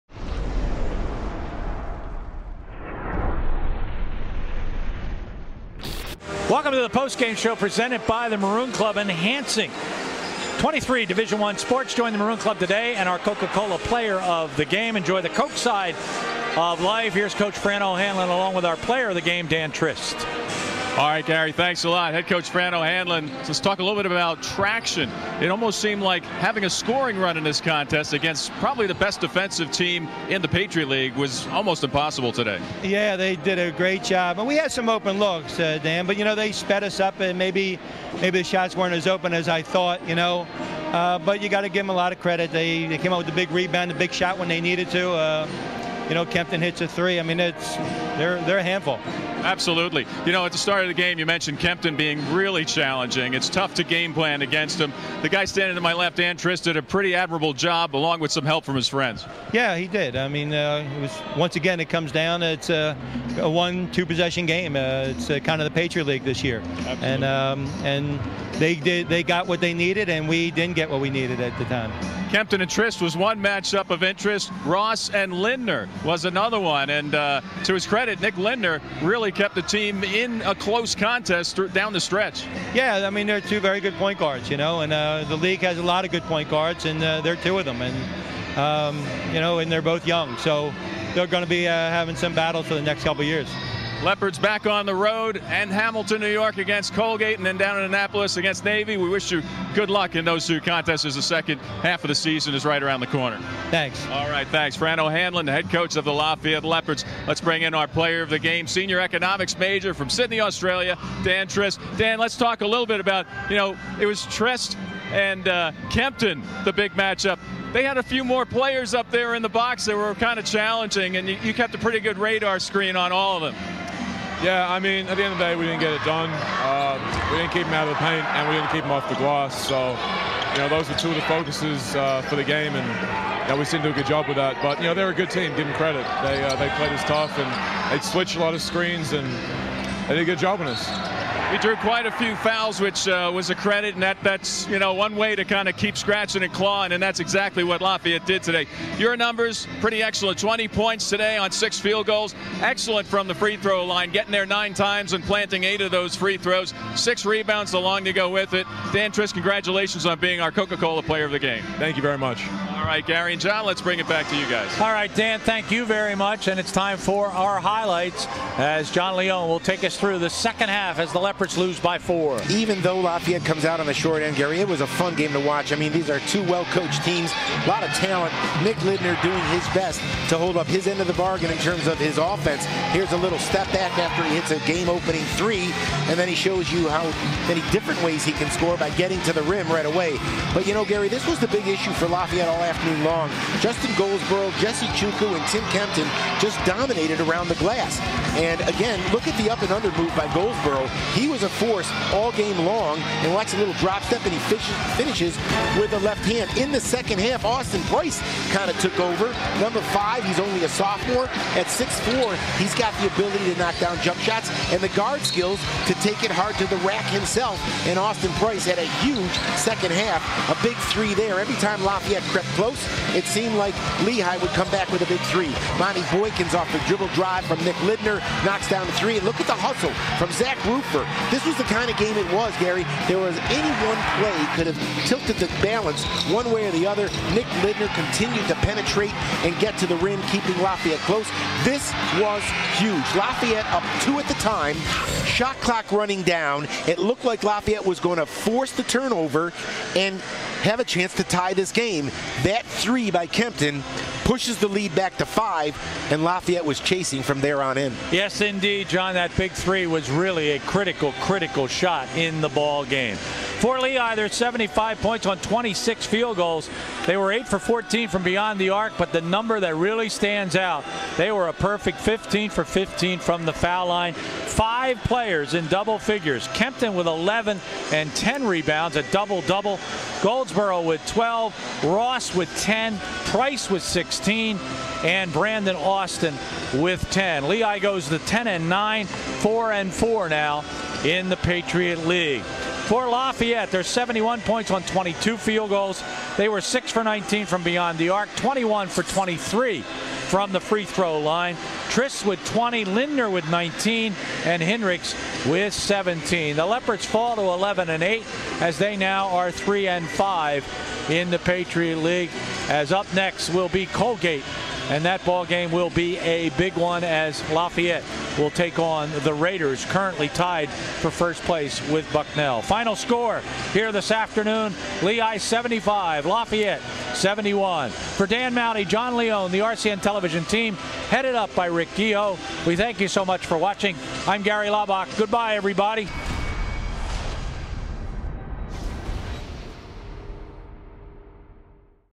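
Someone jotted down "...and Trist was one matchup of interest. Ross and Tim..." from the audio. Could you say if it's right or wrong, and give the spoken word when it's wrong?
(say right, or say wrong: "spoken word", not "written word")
wrong: "Lindner", not "Tim".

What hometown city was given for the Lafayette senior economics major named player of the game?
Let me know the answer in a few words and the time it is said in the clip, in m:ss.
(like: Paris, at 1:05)
Sydney, Australia, at 1:50.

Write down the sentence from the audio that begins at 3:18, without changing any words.
And, again, look at the up-and-under move by Goldsborough.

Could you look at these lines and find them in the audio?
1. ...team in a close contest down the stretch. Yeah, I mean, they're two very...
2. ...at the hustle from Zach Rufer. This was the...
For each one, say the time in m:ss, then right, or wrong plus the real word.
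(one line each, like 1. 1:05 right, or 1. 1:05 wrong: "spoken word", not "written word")
1. 1:19 right
2. 3:49 right.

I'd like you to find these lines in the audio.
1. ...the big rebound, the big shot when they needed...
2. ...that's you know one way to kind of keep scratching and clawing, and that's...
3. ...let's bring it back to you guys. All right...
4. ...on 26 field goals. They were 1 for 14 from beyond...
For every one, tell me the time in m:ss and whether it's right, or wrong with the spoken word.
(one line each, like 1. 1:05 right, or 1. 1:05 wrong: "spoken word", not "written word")
1. 0:43 right
2. 2:24 right
3. 2:43 right
4. 4:25 wrong: "8", not "1".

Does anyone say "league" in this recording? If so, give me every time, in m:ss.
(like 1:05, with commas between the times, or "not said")
0:30, 1:06, 1:25, 4:52, 5:11.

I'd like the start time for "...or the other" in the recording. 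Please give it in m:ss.
3:56.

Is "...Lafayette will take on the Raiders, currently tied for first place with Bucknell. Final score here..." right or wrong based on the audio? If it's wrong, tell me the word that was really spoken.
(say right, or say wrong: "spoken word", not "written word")
right.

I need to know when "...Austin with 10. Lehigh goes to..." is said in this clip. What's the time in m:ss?
4:45.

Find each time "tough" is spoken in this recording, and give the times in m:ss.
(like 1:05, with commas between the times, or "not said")
0:53, 2:17.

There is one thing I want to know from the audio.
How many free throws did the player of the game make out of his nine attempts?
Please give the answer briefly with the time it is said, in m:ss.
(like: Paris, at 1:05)
8, at 2:35.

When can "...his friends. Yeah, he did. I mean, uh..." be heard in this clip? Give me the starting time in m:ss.
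0:58.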